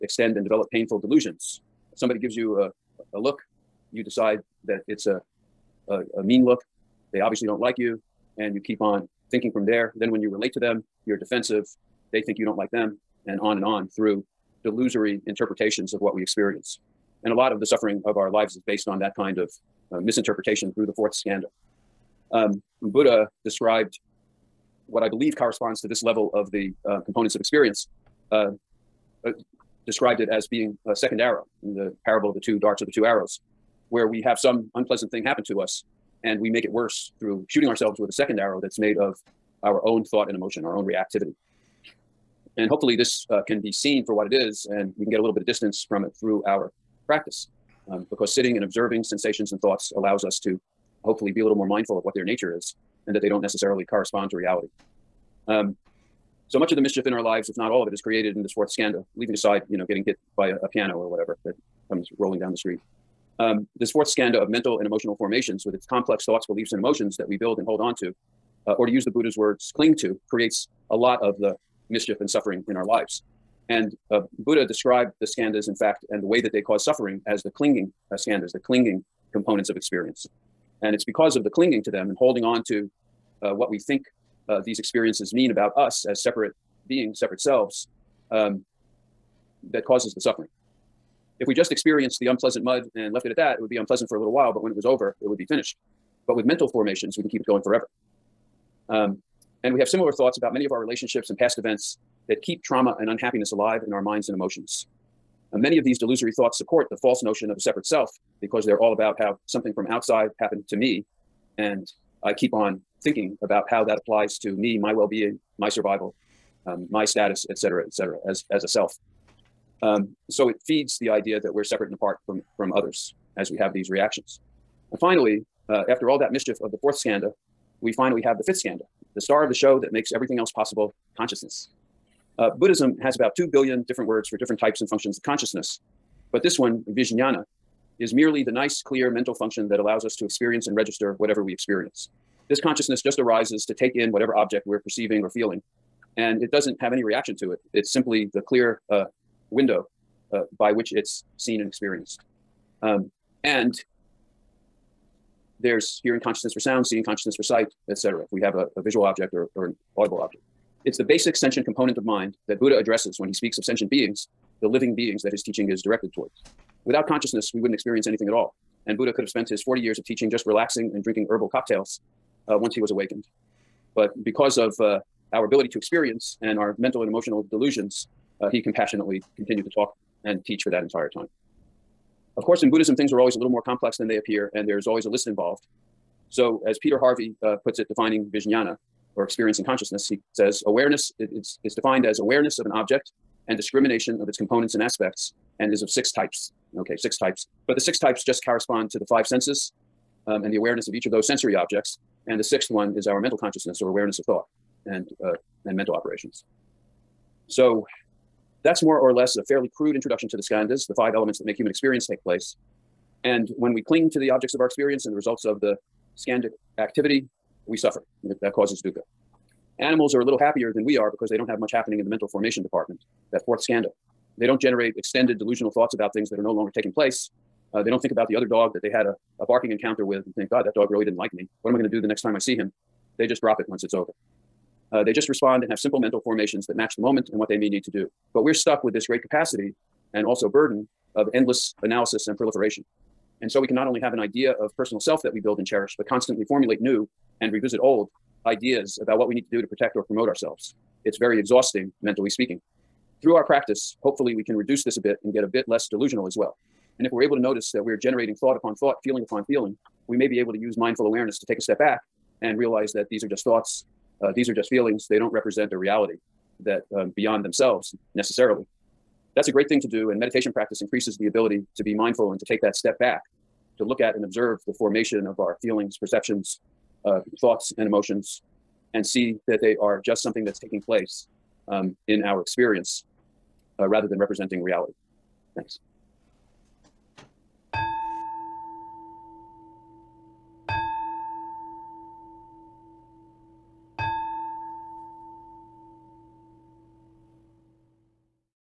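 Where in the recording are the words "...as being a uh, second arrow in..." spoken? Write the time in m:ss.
0:30.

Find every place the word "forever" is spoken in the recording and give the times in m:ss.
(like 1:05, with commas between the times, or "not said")
1:37.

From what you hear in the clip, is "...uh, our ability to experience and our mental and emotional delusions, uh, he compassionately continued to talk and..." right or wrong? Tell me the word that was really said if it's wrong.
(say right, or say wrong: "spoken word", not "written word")
right.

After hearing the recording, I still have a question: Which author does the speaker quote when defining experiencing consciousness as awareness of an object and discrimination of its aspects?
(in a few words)
Peter Harvey.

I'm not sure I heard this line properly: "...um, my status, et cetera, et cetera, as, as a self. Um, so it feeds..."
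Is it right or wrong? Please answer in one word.
right.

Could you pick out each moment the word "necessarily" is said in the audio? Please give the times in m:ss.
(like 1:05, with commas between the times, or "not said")
0:53, 4:28.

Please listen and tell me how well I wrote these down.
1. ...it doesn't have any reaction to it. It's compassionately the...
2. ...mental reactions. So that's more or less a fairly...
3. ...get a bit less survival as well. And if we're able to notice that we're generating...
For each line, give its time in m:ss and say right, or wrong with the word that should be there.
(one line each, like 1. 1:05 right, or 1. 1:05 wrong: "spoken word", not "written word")
1. 2:26 wrong: "simply", not "compassionately"
2. 3:25 wrong: "operations", not "reactions"
3. 4:15 wrong: "delusional", not "survival".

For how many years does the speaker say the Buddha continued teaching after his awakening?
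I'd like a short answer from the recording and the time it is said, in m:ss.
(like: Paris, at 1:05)
40, at 2:49.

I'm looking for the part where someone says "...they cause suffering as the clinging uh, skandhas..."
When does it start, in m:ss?
1:16.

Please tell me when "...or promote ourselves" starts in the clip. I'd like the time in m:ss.
4:09.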